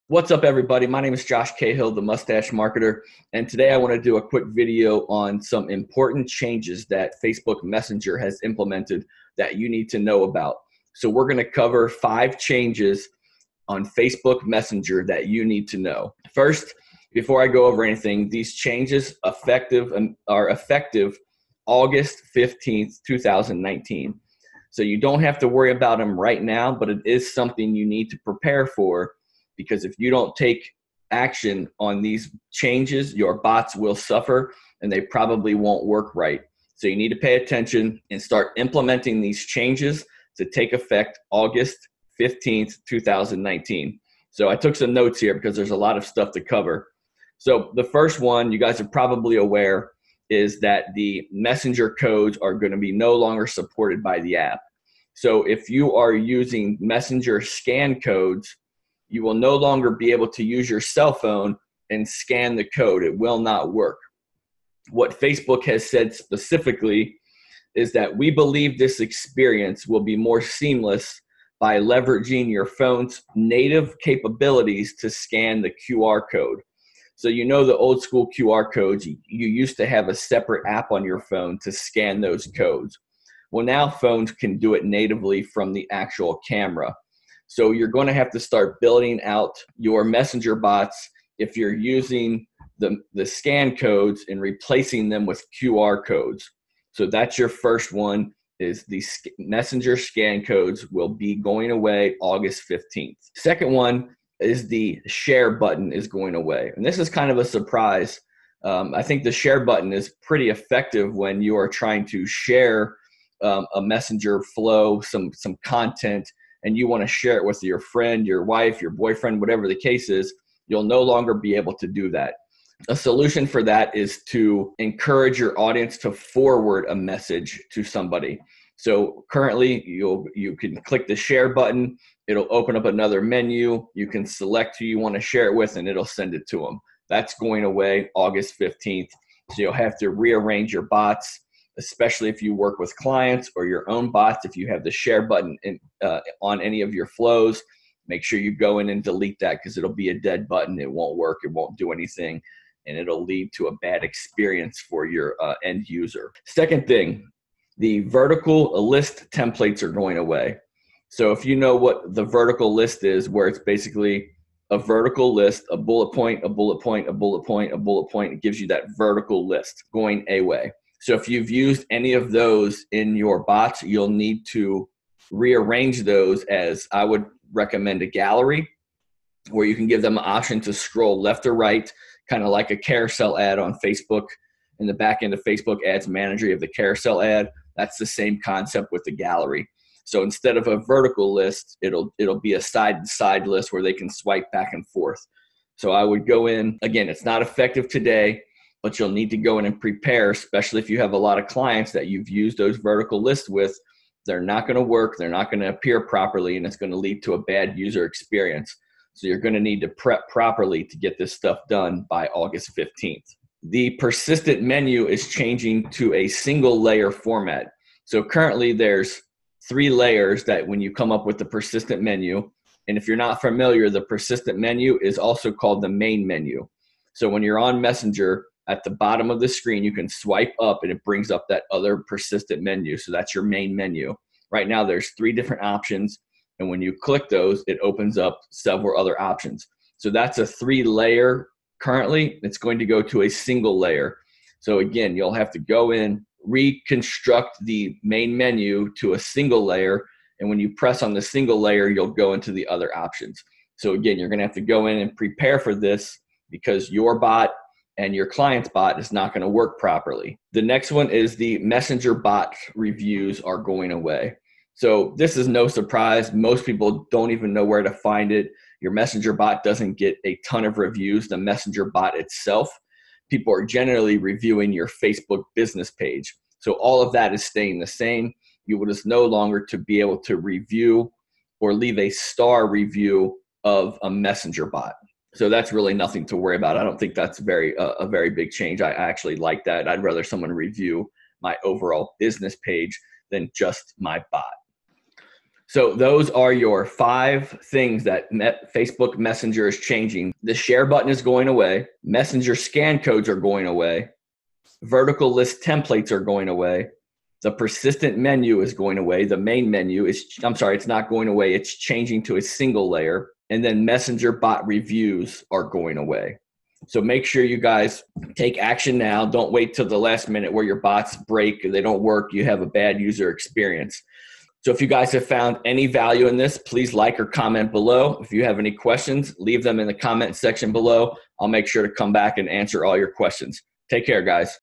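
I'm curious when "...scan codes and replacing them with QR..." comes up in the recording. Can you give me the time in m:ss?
1:33.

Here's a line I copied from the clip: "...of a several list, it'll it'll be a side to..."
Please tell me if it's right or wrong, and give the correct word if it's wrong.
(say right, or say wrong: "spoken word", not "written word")
wrong: "vertical", not "several".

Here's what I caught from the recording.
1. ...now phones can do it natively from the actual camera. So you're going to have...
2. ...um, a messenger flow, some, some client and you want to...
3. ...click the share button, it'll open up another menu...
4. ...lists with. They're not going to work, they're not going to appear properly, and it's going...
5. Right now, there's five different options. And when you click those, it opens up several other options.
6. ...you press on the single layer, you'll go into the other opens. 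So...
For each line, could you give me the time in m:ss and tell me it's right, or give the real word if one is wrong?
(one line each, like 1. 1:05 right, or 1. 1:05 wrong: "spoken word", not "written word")
1. 1:23 right
2. 1:53 wrong: "content", not "client"
3. 2:10 right
4. 3:23 right
5. 3:54 wrong: "three", not "five"
6. 4:10 wrong: "options", not "opens".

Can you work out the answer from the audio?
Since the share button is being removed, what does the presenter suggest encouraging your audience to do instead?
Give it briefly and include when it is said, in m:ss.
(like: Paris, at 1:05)
Forward a message, at 2:06.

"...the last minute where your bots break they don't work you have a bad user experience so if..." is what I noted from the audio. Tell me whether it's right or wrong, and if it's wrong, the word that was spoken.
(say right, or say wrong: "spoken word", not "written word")
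right.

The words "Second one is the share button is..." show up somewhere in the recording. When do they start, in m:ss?
1:43.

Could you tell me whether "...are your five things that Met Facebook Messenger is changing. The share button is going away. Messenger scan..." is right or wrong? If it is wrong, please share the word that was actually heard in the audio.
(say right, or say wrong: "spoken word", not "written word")
right.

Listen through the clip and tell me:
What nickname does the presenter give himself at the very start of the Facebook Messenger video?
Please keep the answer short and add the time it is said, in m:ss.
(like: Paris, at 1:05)
The Mustache Marketer, at 0:01.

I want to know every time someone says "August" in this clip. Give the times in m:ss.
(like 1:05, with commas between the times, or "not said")
0:21, 0:41, 1:42, 2:18, 3:32.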